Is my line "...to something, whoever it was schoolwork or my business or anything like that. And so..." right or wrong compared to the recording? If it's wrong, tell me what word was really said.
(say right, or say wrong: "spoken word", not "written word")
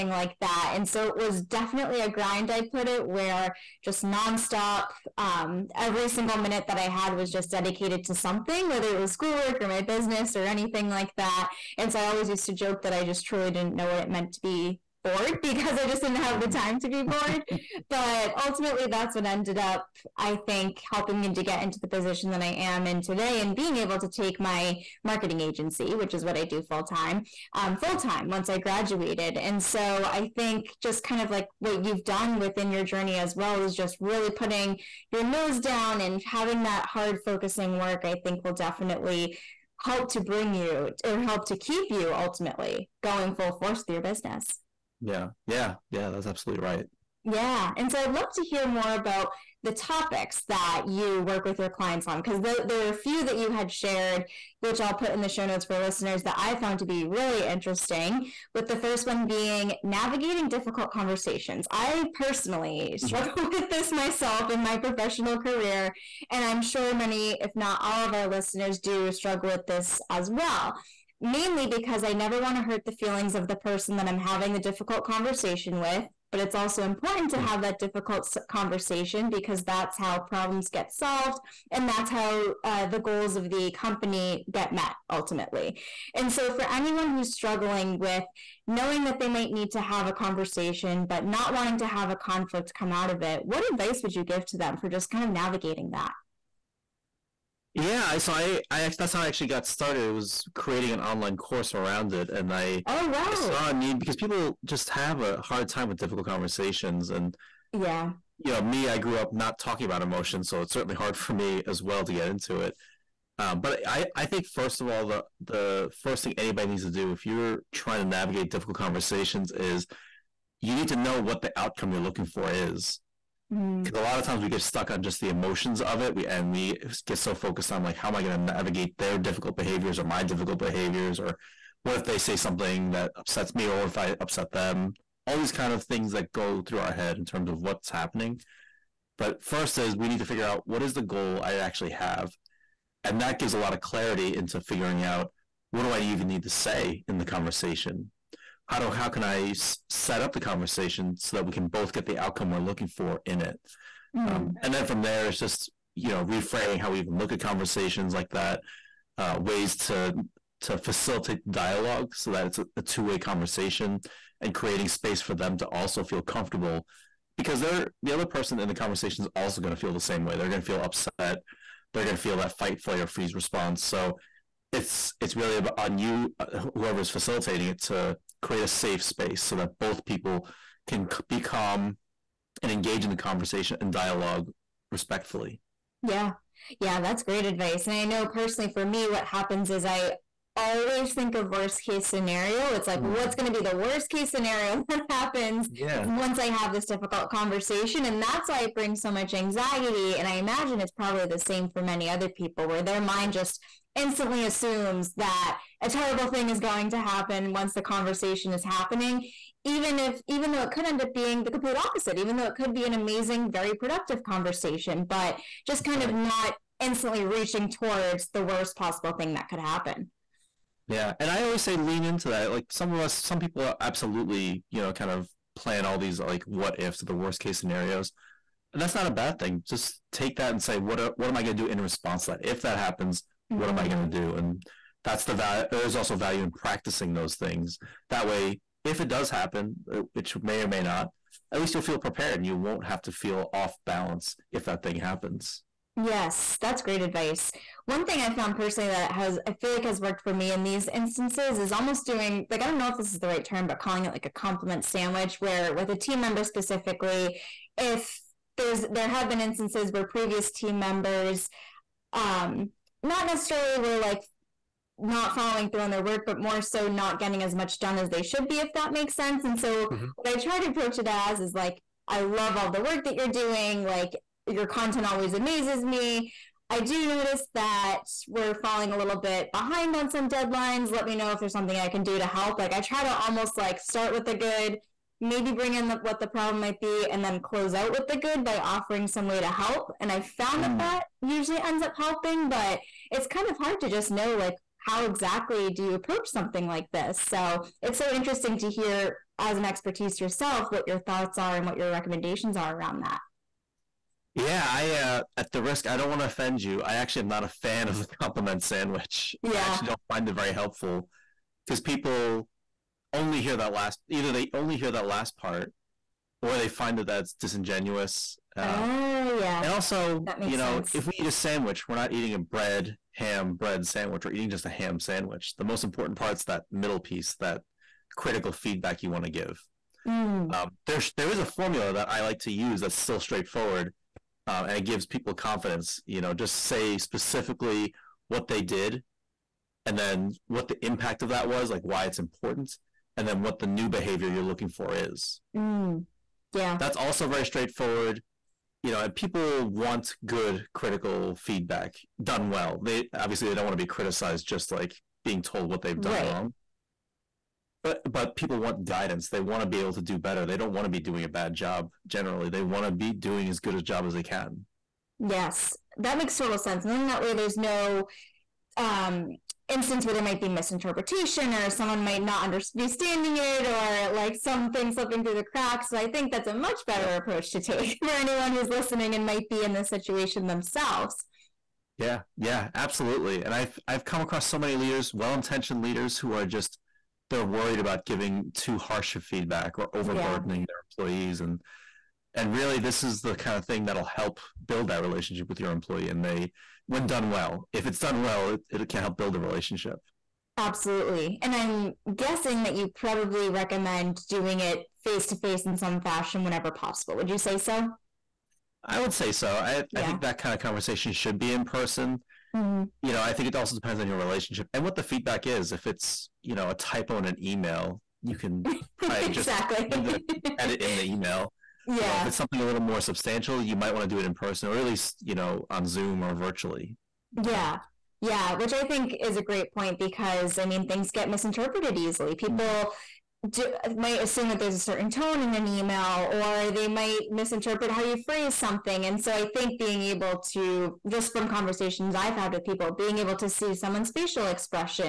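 wrong: "whether", not "whoever".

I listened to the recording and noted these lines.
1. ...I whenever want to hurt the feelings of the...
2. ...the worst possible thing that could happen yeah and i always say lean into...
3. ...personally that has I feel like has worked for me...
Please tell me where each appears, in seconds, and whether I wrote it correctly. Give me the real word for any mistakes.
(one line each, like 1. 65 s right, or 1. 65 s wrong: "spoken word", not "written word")
1. 72 s wrong: "never", not "whenever"
2. 218 s right
3. 248 s right.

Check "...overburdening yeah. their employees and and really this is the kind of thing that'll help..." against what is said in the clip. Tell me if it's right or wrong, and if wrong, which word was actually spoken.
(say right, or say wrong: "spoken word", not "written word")
right.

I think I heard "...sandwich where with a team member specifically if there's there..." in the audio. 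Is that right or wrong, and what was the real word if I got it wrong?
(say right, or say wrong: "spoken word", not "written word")
right.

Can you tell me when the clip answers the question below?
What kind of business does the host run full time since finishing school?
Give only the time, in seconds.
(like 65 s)
25 s.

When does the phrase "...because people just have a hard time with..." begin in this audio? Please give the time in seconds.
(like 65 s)
104 s.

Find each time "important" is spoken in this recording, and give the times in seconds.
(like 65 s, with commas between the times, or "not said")
76 s, 325 s, 342 s.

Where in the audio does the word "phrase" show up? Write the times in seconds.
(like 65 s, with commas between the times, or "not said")
438 s.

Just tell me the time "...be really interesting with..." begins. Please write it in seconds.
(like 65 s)
56 s.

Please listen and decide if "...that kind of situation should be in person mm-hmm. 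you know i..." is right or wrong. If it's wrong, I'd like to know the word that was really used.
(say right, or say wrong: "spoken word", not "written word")
wrong: "conversation", not "situation".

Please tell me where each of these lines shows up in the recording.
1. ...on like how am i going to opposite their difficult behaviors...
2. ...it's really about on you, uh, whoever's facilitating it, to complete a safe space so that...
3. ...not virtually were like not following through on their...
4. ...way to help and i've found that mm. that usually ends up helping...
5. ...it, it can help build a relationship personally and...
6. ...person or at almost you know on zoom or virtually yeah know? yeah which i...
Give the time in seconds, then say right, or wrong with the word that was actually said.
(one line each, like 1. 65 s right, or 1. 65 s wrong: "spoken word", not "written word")
1. 127 s wrong: "navigate", not "opposite"
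2. 175 s wrong: "create", not "complete"
3. 263 s wrong: "necessarily", not "virtually"
4. 289 s right
5. 398 s wrong: "absolutely", not "personally"
6. 424 s wrong: "least", not "almost".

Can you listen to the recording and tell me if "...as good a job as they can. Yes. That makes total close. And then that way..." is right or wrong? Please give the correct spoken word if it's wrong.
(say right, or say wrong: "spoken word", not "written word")
wrong: "sense", not "close".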